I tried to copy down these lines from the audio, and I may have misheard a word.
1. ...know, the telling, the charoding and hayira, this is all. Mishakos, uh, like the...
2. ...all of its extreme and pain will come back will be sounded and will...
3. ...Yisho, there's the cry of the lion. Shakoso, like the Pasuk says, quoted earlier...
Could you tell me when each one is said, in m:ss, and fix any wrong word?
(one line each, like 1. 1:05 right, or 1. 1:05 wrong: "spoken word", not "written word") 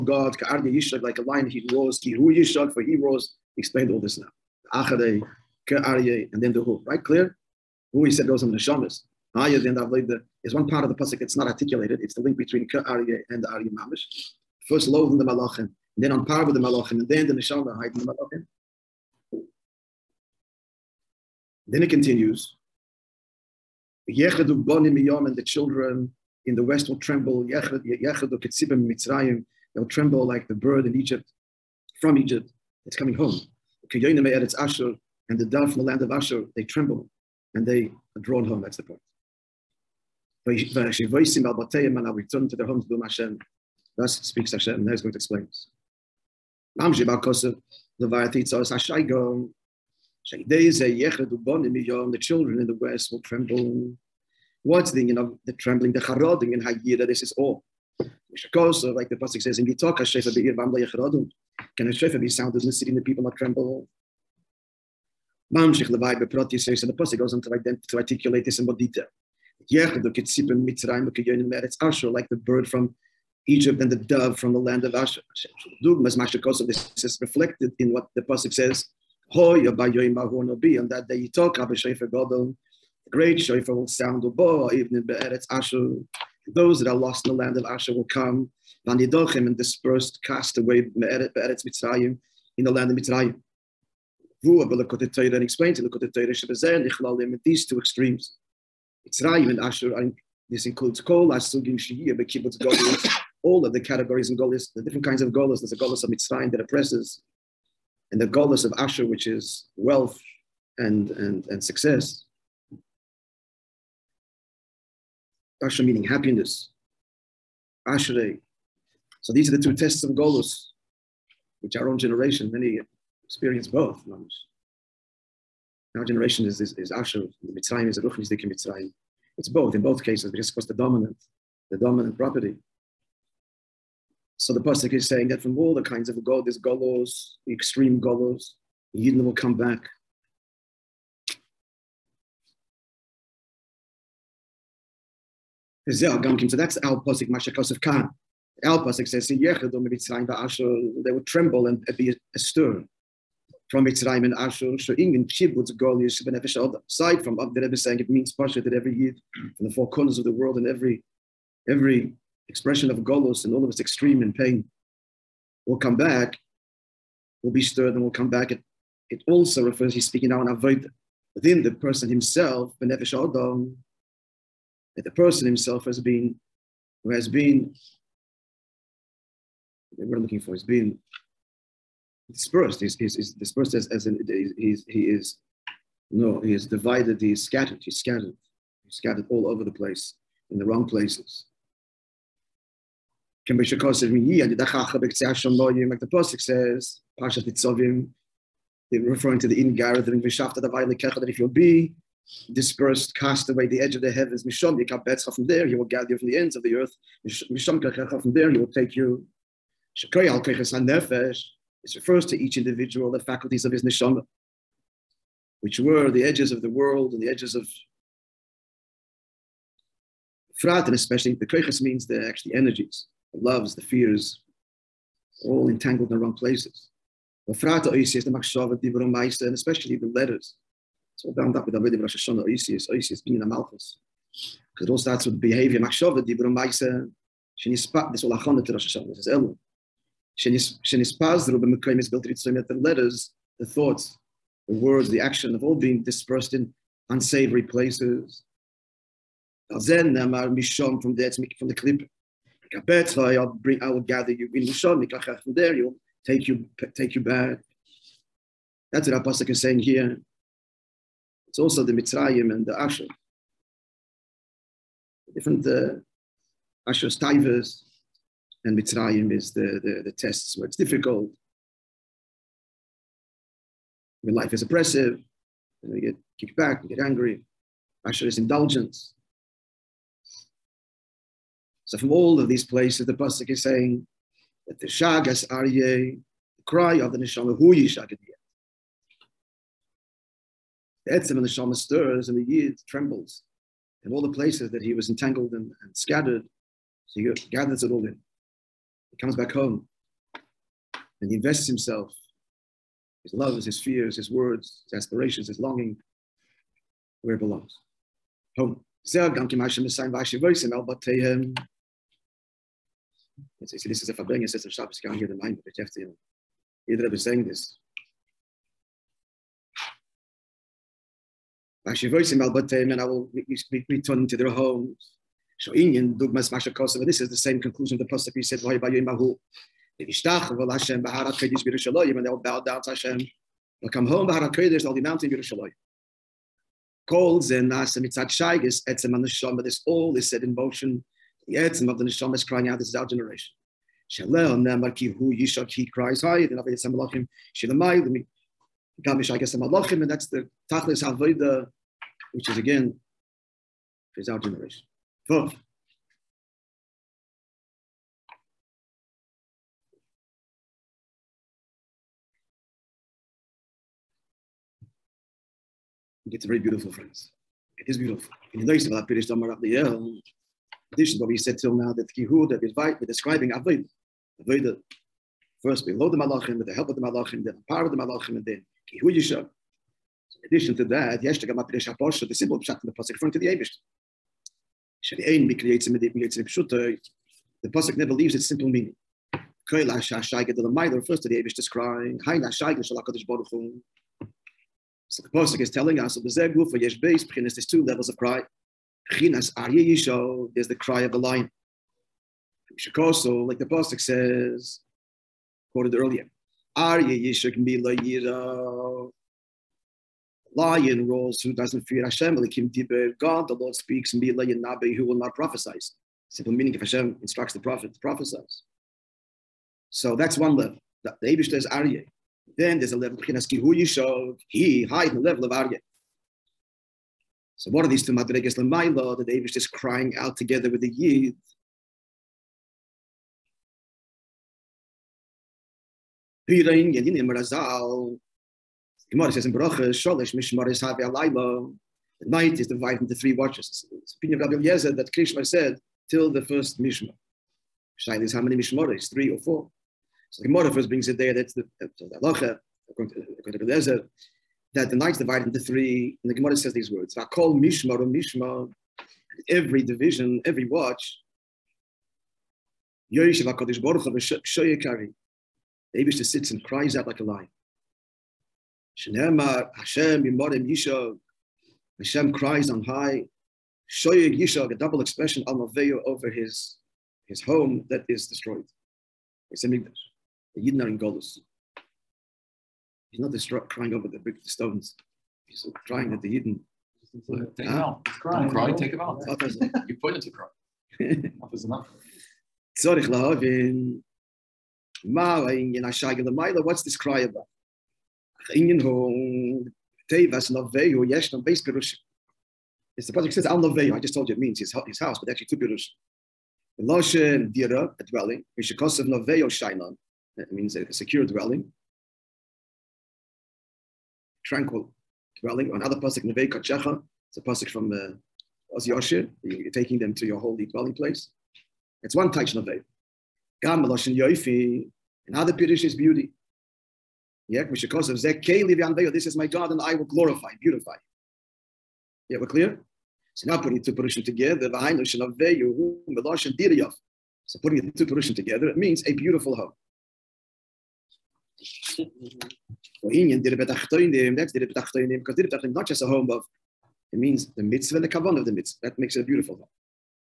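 1. 0:55 wrong: "trembling", not "telling"
2. 2:43 wrong: "stirred", not "sounded"
3. 6:39 right.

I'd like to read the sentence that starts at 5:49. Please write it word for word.
Gamish I guess the malachim, and that's the tachlis avoda which is again, is our generation.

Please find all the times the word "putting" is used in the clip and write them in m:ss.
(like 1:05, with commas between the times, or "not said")
8:53, 8:57.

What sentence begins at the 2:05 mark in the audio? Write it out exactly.
Our generation is, is, is Asher, the Mitzrayim is a Ruchnisdik in Mitzrayim.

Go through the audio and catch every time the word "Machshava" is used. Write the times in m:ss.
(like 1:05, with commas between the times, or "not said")
3:48, 3:55.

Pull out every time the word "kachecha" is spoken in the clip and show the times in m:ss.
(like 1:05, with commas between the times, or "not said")
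3:27, 8:36.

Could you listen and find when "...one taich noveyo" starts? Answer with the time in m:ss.
8:42.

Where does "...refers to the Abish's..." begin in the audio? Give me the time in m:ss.
6:30.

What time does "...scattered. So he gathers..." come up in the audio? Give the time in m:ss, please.
4:55.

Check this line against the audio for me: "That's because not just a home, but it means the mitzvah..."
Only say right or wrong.
right.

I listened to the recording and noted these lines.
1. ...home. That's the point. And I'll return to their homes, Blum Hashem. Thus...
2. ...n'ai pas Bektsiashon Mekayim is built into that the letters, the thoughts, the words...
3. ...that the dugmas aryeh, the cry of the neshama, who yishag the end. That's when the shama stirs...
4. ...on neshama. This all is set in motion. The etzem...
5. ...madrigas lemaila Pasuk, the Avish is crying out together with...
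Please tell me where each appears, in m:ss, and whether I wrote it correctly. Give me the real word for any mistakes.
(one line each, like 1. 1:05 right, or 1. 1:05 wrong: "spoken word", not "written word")
1. 0:38 right
2. 4:00 wrong: "Ruben", not "Bektsiashon"
3. 4:44 wrong: "shagas", not "dugmas"
4. 5:39 right
5. 7:08 wrong: "Mayla", not "Pasuk".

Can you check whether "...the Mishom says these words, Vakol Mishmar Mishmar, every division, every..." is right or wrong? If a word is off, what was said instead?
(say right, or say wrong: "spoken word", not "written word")
wrong: "Gemara", not "Mishom".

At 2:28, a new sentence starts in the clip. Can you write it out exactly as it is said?
Al posik says in Yechidu mitzrayim ba'ashur they would tremble and be astir from Mitzrayim and Ashur.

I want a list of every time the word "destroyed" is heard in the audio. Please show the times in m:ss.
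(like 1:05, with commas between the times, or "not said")
7:58, 8:03.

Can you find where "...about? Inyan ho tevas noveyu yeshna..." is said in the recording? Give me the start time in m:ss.
8:17.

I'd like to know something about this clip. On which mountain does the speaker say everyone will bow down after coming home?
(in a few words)
mountain Yerushalayim.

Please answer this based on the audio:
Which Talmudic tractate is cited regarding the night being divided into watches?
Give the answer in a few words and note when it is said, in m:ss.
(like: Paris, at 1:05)
Berachos, at 7:19.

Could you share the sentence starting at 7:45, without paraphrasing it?
Abishah sits and cries out like a lion.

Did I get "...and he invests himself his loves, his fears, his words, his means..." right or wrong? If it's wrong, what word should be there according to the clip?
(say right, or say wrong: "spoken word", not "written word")
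wrong: "aspirations", not "means".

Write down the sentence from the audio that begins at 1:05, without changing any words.
Mamshich be'proti says and the Pasuk goes on to, ident- to articulate this in more detail.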